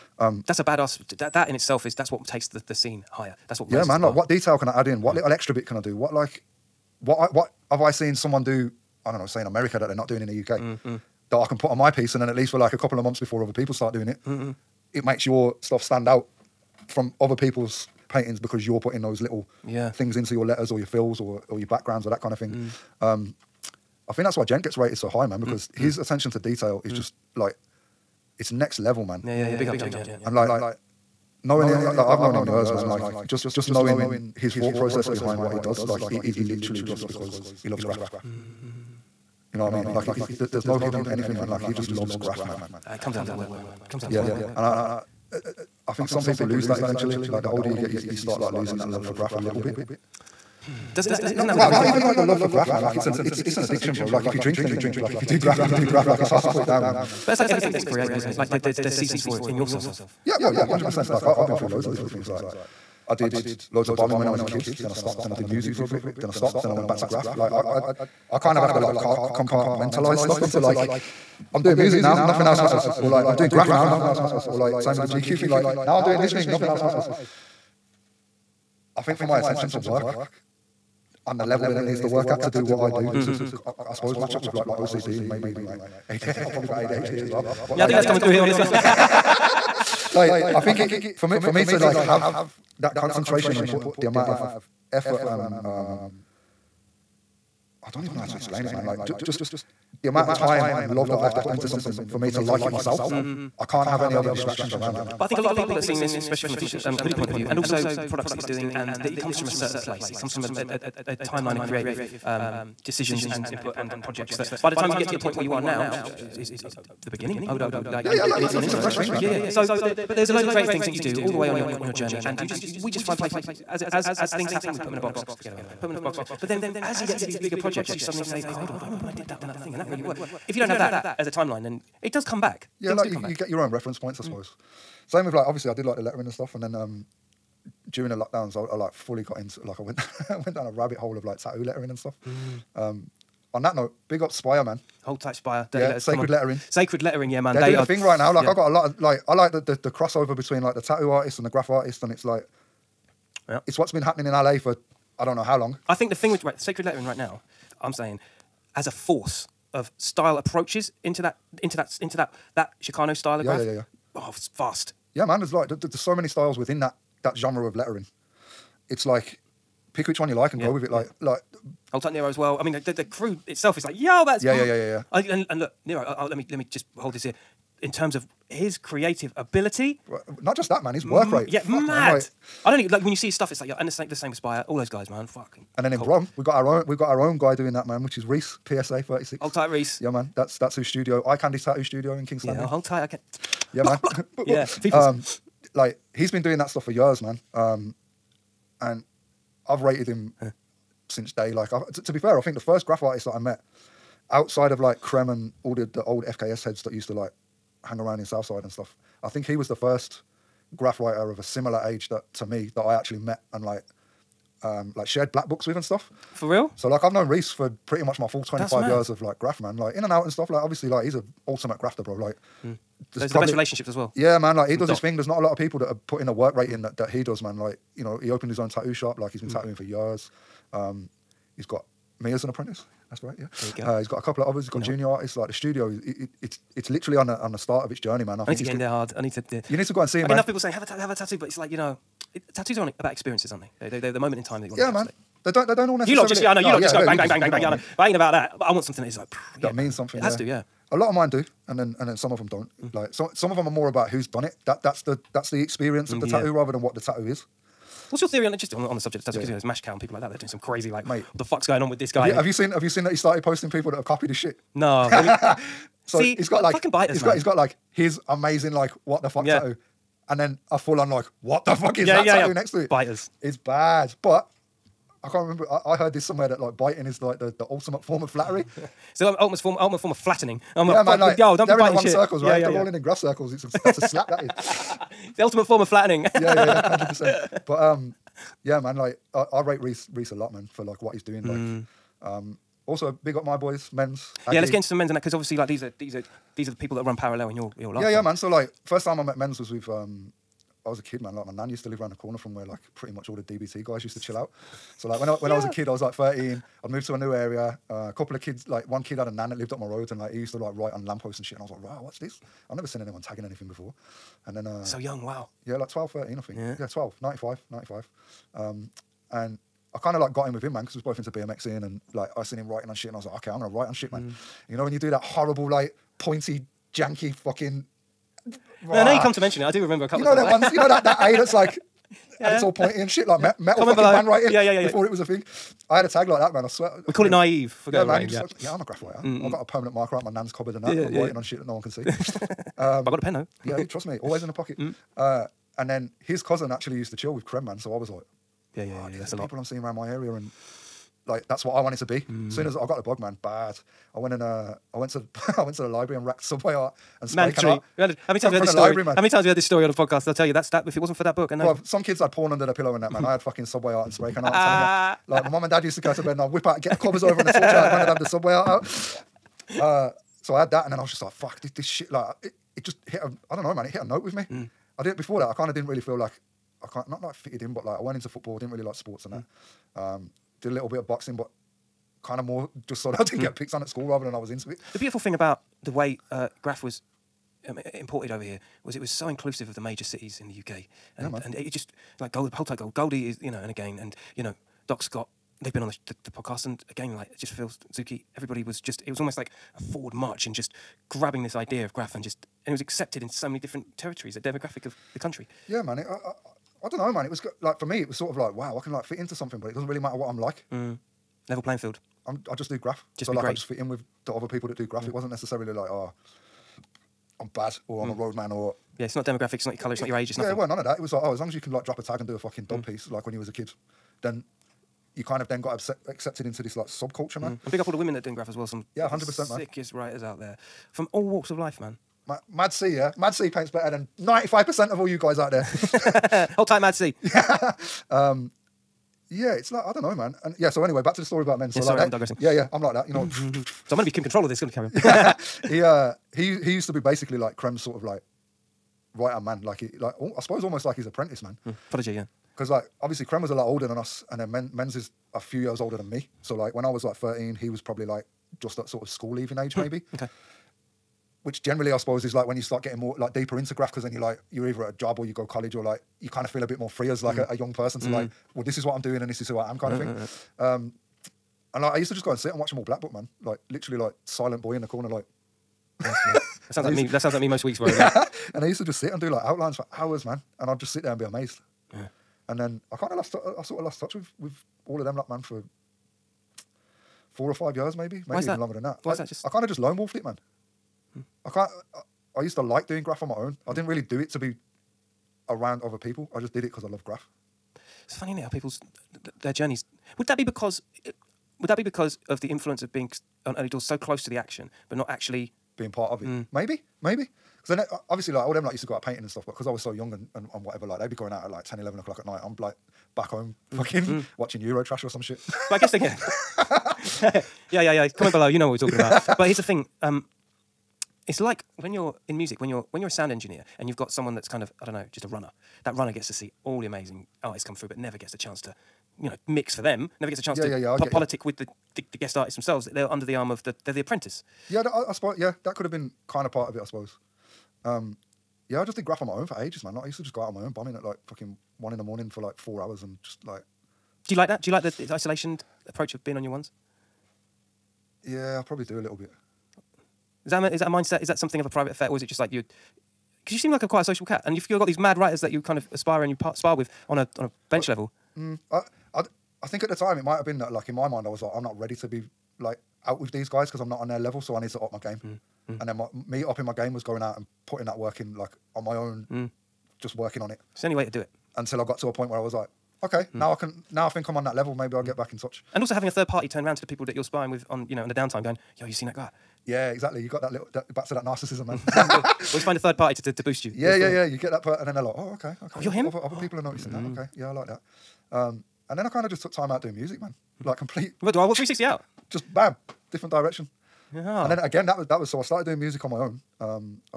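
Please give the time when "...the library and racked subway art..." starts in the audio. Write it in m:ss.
5:55.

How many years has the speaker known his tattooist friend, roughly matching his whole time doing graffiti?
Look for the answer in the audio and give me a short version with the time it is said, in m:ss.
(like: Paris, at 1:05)
25, at 3:38.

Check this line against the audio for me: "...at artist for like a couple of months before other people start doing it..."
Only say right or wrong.
wrong.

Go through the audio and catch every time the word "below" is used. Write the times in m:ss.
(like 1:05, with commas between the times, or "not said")
5:33, 8:38.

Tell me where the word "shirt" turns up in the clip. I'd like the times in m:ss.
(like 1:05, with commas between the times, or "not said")
1:46.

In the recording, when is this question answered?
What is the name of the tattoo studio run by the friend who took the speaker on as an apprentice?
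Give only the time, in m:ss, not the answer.
3:11.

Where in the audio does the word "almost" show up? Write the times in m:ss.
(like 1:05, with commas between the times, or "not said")
6:39, 7:30.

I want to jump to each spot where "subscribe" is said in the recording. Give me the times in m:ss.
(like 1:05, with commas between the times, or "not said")
not said.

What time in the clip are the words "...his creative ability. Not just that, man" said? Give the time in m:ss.
2:58.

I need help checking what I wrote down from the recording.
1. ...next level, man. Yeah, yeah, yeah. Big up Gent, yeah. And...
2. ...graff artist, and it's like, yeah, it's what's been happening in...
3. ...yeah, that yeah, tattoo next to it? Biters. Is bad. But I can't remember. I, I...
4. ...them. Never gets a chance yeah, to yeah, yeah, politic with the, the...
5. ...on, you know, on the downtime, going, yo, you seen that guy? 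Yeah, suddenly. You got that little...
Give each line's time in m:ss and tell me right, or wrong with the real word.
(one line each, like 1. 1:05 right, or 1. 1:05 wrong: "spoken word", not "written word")
1. 0:28 right
2. 2:31 right
3. 4:32 right
4. 8:49 right
5. 9:37 wrong: "exactly", not "suddenly".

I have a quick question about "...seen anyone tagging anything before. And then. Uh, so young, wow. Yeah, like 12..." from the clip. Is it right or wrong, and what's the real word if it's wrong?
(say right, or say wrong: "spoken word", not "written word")
right.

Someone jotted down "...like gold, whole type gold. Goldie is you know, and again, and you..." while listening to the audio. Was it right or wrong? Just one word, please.
right.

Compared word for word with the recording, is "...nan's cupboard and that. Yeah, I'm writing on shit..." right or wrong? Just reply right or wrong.
right.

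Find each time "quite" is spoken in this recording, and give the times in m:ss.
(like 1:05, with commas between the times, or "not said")
9:13.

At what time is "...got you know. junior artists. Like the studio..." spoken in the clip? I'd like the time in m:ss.
3:54.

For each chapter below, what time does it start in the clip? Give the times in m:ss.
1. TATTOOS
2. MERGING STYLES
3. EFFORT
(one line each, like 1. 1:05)
1. 3:23
2. 2:37
3. 1:31.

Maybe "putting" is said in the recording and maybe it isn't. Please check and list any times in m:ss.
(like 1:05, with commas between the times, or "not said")
0:18, 3:46, 9:27.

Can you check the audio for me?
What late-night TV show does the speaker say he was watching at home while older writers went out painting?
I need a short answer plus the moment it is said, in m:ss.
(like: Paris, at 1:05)
Eurotrash, at 8:34.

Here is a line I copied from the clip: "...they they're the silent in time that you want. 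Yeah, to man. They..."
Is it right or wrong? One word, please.
wrong.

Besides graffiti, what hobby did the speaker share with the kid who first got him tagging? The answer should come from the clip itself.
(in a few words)
BMXing.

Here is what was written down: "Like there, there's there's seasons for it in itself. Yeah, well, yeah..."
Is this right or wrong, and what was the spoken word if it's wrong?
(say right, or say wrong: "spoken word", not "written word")
wrong: "yourself", not "itself".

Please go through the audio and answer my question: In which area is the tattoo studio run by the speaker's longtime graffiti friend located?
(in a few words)
Kingsland.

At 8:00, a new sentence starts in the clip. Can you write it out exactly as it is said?
And I'd just sit there and be amazed.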